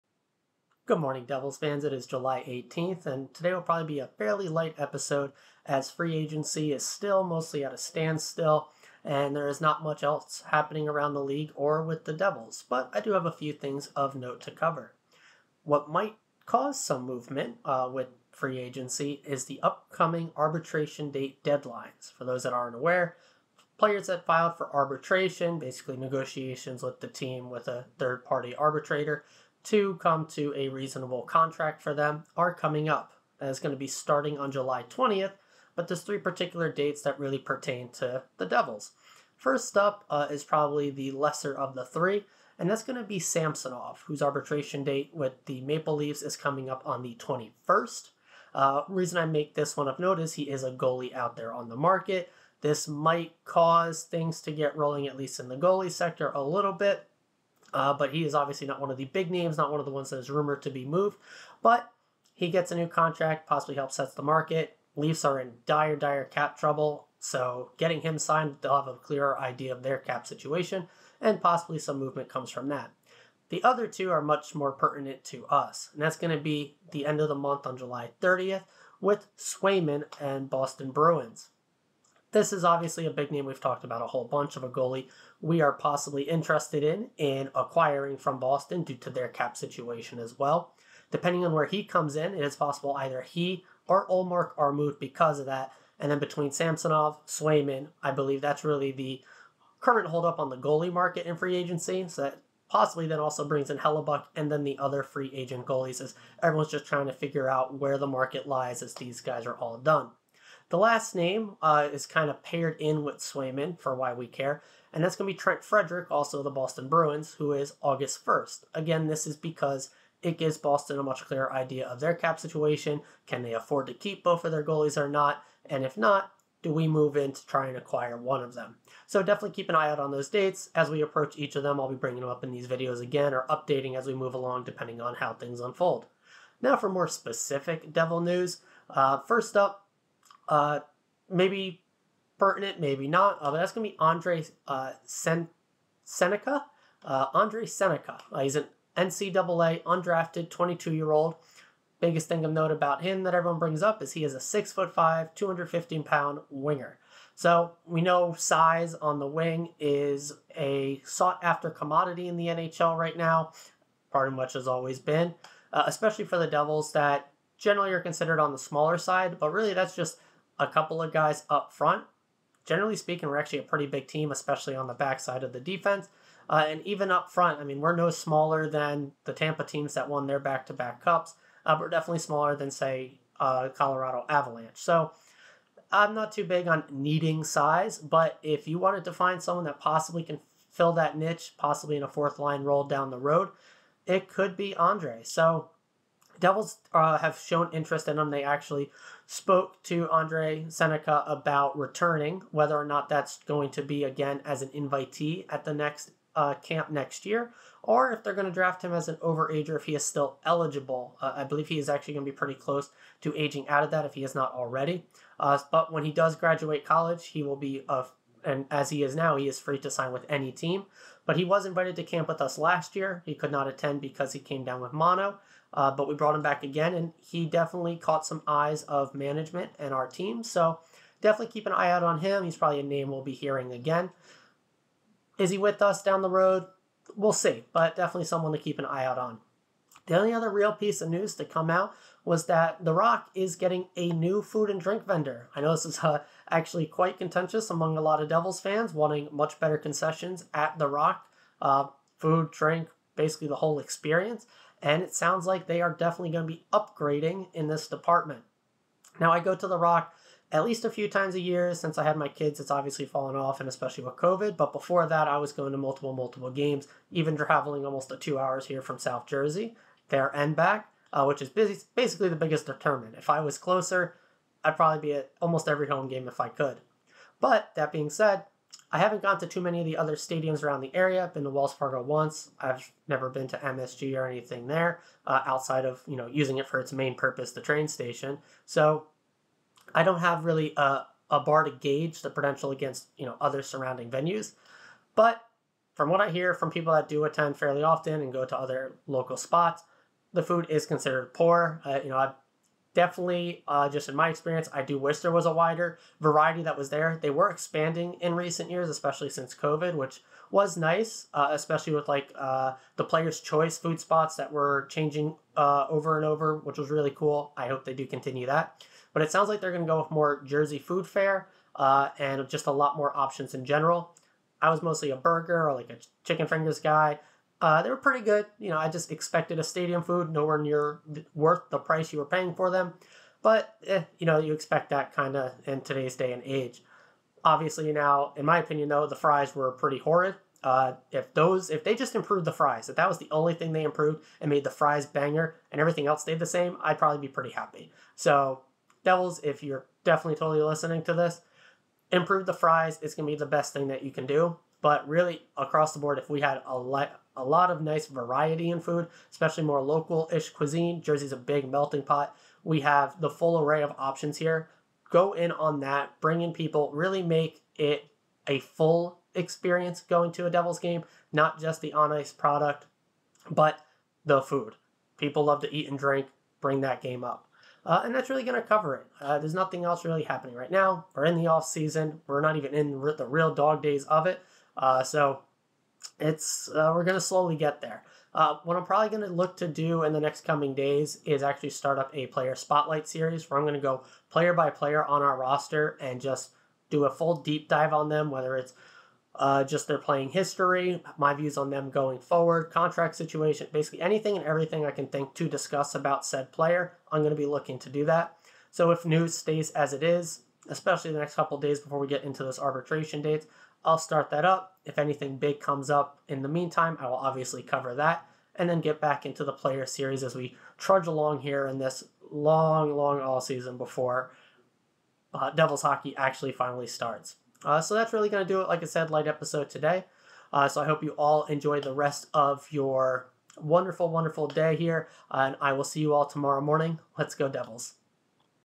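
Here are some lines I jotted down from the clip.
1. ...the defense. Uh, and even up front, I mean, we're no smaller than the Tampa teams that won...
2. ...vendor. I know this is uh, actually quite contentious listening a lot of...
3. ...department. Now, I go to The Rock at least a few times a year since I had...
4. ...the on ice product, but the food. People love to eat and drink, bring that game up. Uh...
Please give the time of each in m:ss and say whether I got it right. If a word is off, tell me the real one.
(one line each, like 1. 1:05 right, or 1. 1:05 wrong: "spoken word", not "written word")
1. 2:55 right
2. 4:05 wrong: "among", not "listening"
3. 4:17 right
4. 6:11 right.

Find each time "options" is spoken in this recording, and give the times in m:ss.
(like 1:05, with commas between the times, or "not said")
5:23, 6:03.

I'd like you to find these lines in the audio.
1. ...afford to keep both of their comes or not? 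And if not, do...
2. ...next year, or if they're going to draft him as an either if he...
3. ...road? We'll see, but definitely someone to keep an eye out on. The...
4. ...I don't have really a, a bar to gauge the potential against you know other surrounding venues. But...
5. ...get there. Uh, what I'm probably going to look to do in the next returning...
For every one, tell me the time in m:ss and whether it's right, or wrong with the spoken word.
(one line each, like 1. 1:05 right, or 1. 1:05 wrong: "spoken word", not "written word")
1. 2:03 wrong: "goalies", not "comes"
2. 3:26 wrong: "overager", not "either"
3. 3:56 right
4. 4:49 right
5. 6:27 wrong: "coming", not "returning".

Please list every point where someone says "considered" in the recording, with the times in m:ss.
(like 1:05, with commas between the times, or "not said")
2:48, 5:00.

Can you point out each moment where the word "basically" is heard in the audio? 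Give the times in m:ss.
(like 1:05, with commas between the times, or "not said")
0:25, 4:13, 4:31, 6:43.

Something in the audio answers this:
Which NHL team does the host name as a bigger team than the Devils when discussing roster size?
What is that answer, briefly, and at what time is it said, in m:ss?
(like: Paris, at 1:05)
Colorado Avalanche, at 3:03.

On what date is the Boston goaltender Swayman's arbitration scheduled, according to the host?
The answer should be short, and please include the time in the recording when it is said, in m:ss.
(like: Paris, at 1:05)
July 30th, at 1:17.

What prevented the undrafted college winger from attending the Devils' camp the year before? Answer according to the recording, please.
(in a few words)
mono.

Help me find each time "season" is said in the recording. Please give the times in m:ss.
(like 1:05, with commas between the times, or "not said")
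6:21, 7:03.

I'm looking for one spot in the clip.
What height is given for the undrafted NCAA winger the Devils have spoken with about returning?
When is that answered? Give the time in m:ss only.
2:34.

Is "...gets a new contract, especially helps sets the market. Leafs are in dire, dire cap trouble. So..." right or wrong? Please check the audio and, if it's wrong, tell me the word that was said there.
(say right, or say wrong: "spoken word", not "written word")
wrong: "possibly", not "especially".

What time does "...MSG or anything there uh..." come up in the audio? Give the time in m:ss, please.
4:43.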